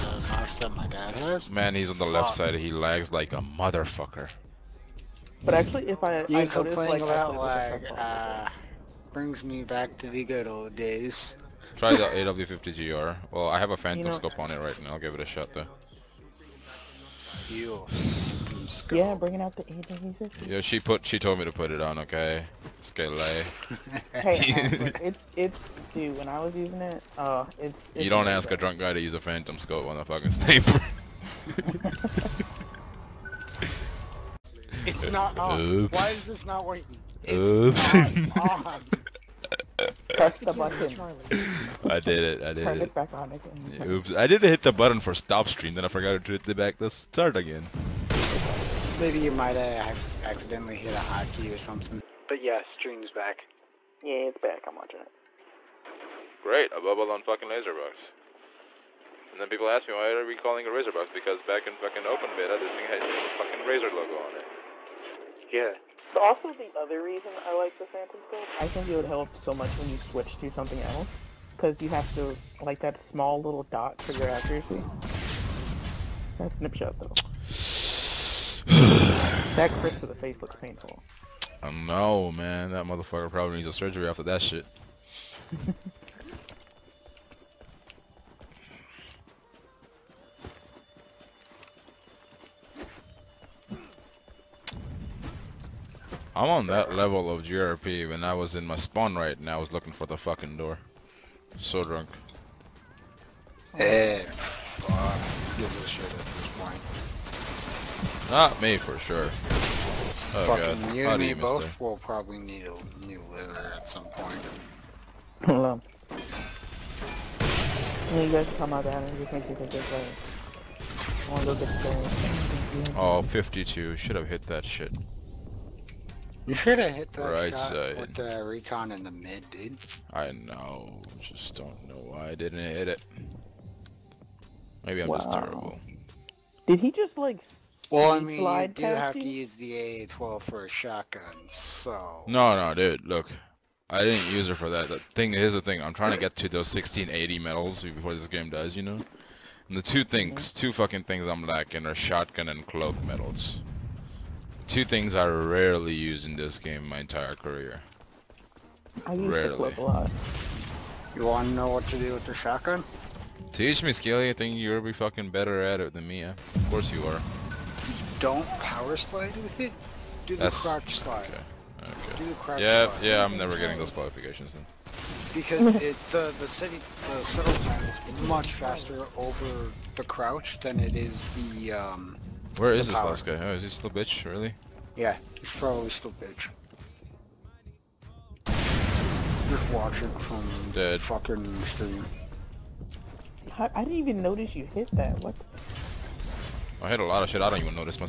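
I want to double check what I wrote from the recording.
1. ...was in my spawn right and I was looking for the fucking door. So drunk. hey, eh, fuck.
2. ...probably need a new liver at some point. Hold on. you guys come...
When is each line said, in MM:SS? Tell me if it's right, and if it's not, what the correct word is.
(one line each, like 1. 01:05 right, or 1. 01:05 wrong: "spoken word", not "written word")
1. 01:38 right
2. 01:51 right.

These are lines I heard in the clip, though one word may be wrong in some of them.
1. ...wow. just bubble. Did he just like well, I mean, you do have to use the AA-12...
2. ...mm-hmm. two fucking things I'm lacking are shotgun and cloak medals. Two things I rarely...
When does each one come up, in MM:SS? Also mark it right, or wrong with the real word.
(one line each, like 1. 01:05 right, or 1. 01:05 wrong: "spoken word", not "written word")
1. 02:15 wrong: "terrible", not "bubble"
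2. 02:30 right.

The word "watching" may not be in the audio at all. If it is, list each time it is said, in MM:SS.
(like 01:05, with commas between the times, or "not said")
00:54, 03:09.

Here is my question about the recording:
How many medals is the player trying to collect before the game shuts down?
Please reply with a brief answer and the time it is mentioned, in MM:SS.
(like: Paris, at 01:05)
1680, at 02:26.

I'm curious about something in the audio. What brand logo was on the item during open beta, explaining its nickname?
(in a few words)
Razer.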